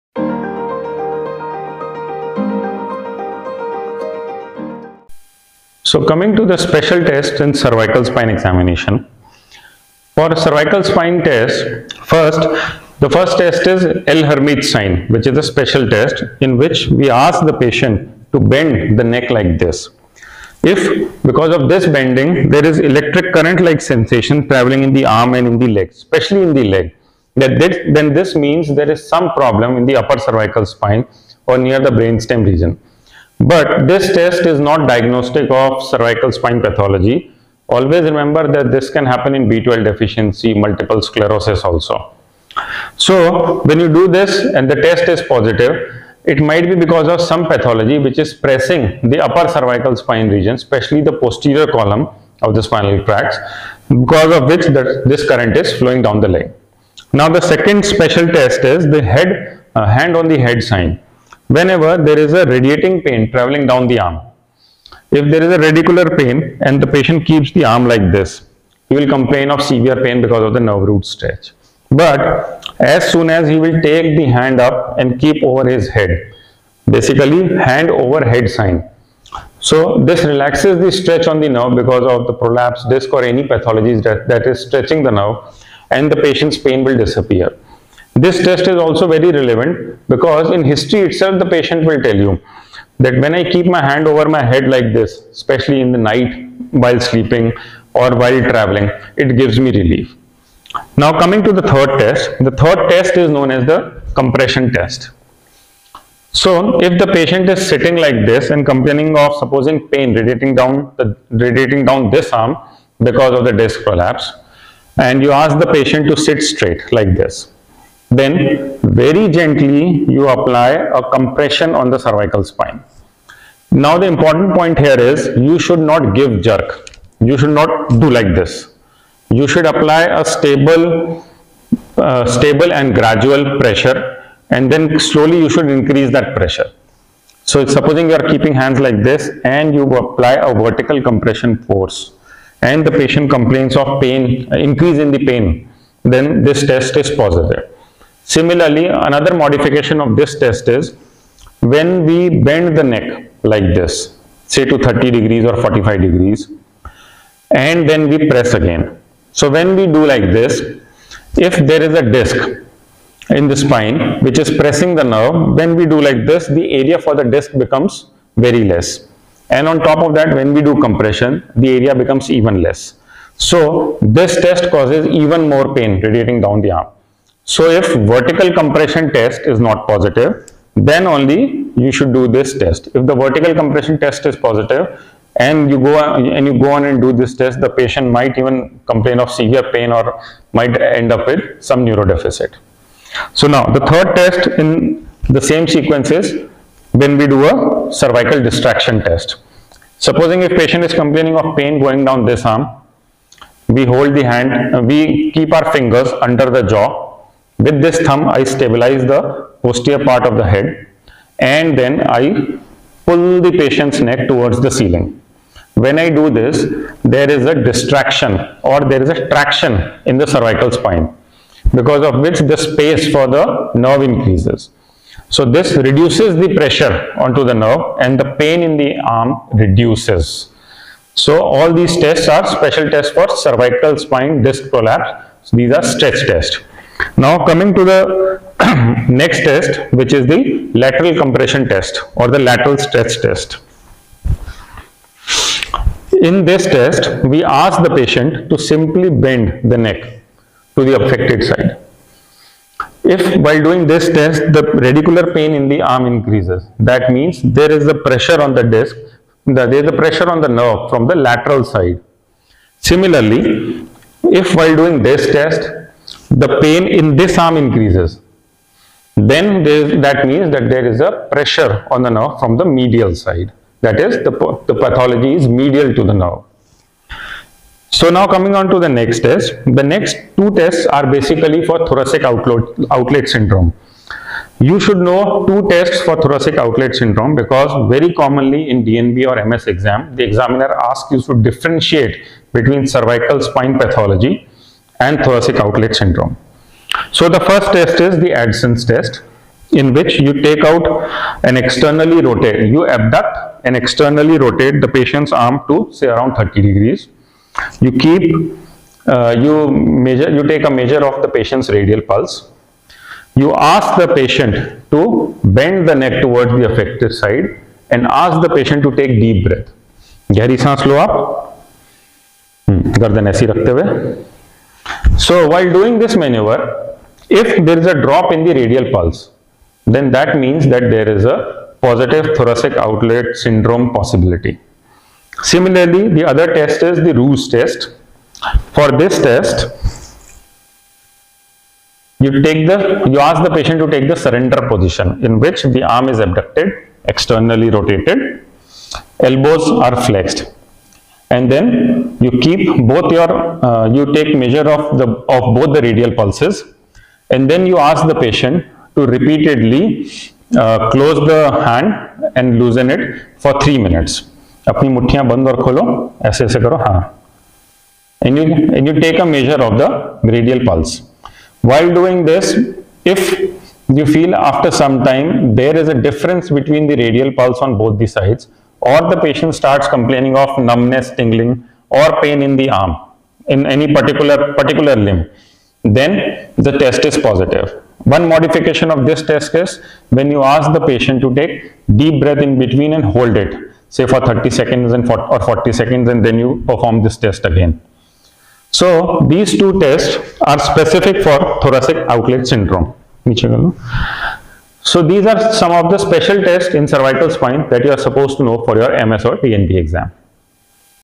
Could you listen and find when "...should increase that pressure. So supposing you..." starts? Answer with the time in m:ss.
2:15.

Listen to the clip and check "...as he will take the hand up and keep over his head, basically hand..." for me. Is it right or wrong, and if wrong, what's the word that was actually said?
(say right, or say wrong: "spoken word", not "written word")
right.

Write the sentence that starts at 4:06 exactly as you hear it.
In this test, we ask the patient to simply bend the neck to the affected side.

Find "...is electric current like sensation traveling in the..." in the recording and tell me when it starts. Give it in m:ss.
0:22.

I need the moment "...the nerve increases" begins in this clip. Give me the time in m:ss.
3:43.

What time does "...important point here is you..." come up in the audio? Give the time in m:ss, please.
2:04.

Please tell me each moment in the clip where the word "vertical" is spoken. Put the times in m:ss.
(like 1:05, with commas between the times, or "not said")
2:20, 2:58, 3:03.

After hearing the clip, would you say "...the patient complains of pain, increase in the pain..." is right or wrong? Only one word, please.
right.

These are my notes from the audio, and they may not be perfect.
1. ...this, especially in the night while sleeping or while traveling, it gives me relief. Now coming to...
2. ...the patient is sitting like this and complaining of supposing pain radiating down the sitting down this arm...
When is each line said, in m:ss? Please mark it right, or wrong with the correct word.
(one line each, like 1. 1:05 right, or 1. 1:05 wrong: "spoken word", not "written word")
1. 1:34 right
2. 1:46 wrong: "radiating", not "sitting".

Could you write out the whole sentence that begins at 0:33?
But this test is not diagnostic of cervical spine pathology.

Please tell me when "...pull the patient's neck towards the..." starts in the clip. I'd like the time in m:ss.
3:33.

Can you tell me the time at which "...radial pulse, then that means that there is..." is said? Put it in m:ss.
5:28.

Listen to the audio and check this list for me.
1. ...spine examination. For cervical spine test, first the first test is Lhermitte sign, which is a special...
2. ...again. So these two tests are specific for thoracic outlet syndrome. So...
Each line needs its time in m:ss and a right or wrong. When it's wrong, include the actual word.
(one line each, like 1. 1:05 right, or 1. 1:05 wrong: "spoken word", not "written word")
1. 0:08 right
2. 6:37 right.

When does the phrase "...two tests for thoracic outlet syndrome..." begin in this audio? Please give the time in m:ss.
4:45.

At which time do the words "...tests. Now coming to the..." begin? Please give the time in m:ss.
3:56.